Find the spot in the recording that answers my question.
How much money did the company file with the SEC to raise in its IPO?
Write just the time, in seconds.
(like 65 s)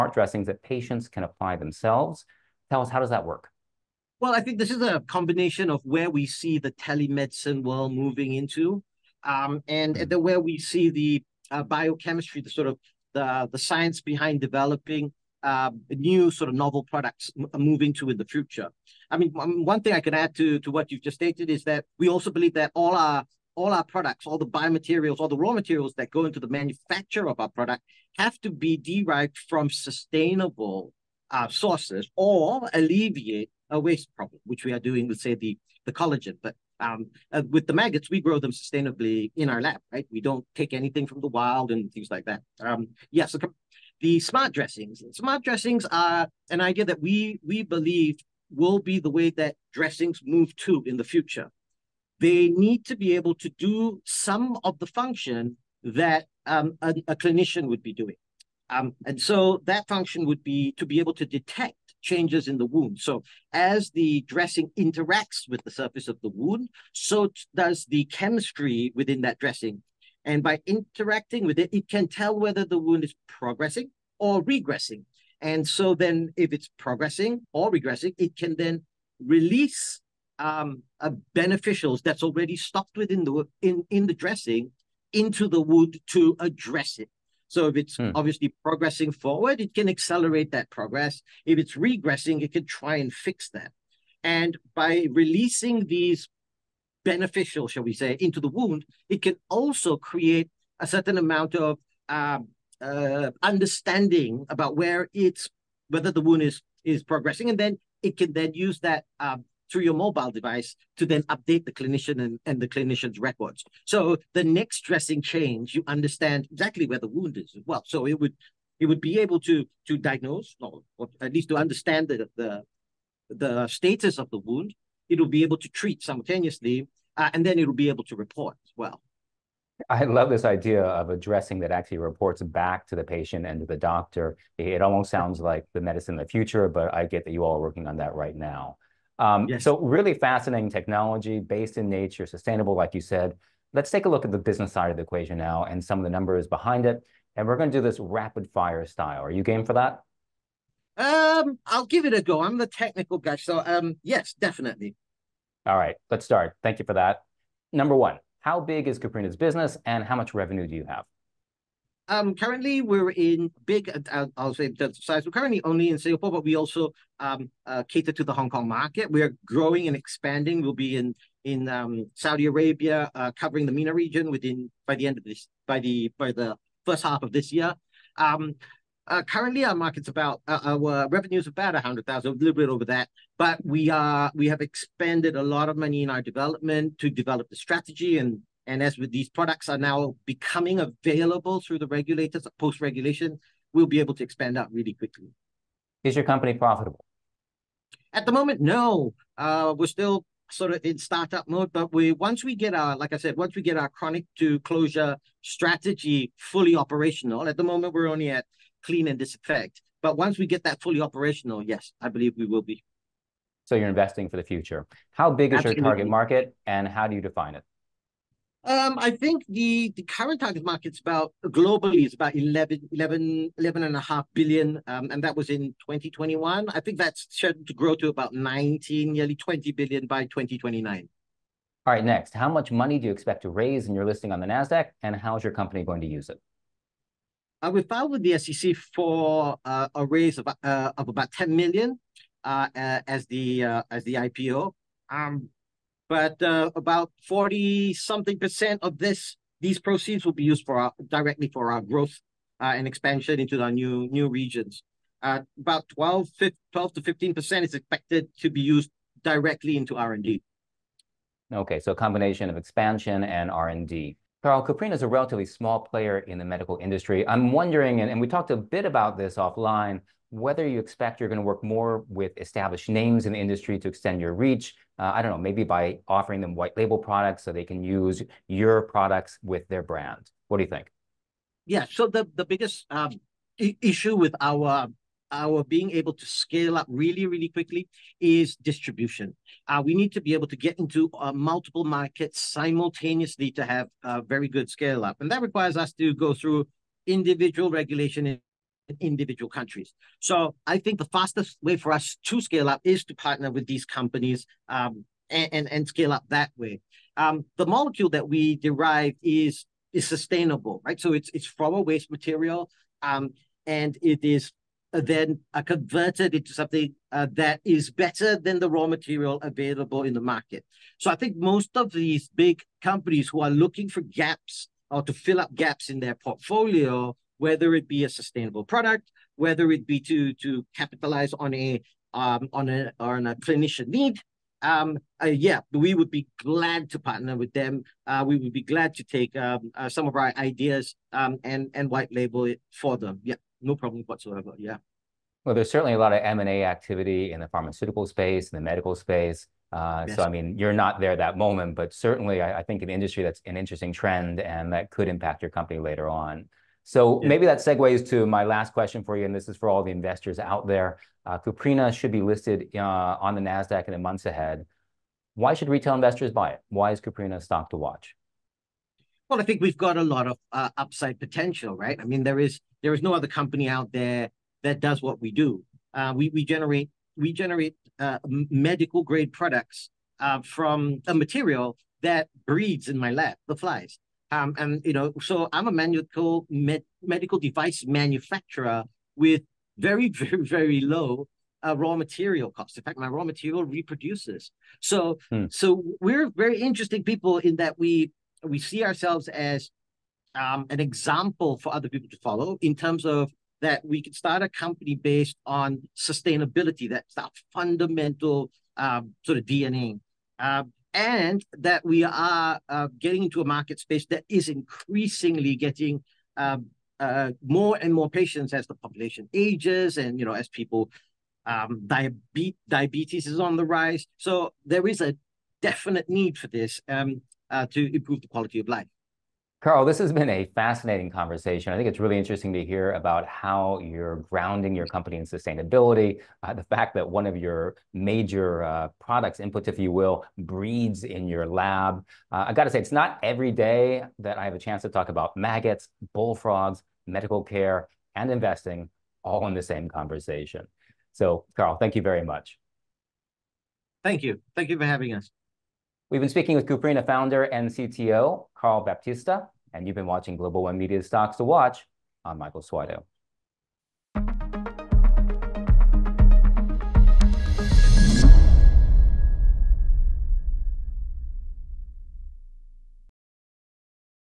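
241 s.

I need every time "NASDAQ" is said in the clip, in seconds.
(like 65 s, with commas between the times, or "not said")
234 s, 363 s.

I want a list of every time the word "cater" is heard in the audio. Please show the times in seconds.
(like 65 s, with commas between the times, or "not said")
167 s.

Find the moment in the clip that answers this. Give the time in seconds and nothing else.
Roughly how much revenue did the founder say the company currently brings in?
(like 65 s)
181 s.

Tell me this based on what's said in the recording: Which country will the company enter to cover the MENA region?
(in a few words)
Saudi Arabia.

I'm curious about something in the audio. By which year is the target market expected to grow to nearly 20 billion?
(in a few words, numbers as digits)
2029.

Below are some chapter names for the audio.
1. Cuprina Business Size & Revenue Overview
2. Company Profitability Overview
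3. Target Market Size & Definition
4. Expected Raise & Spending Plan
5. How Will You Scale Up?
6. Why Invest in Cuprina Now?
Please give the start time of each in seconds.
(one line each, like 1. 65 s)
1. 138 s
2. 195 s
3. 214 s
4. 231 s
5. 264 s
6. 356 s.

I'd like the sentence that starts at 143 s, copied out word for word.
Let's take a look at the business side of the equation now and some of the numbers behind it.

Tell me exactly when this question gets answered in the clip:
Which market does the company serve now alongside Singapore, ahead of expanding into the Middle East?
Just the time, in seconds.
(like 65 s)
168 s.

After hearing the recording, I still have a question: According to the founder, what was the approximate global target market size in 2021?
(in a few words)
11.5 billion.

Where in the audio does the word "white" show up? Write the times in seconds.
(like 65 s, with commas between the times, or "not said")
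276 s, 341 s.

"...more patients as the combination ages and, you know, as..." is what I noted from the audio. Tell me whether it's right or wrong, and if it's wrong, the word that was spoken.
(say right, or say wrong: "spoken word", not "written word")
wrong: "population", not "combination".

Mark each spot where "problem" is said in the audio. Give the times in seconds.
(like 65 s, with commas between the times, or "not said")
34 s, 343 s.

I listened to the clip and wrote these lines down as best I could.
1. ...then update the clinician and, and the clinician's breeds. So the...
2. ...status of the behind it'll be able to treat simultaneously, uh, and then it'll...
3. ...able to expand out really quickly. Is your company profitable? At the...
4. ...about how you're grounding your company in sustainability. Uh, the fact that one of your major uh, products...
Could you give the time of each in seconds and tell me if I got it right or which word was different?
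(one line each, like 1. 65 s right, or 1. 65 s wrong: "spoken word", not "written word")
1. 111 s wrong: "records", not "breeds"
2. 123 s wrong: "wound", not "behind"
3. 193 s right
4. 432 s right.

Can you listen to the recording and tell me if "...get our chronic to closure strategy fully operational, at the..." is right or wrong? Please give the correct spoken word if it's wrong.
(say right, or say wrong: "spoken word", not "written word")
right.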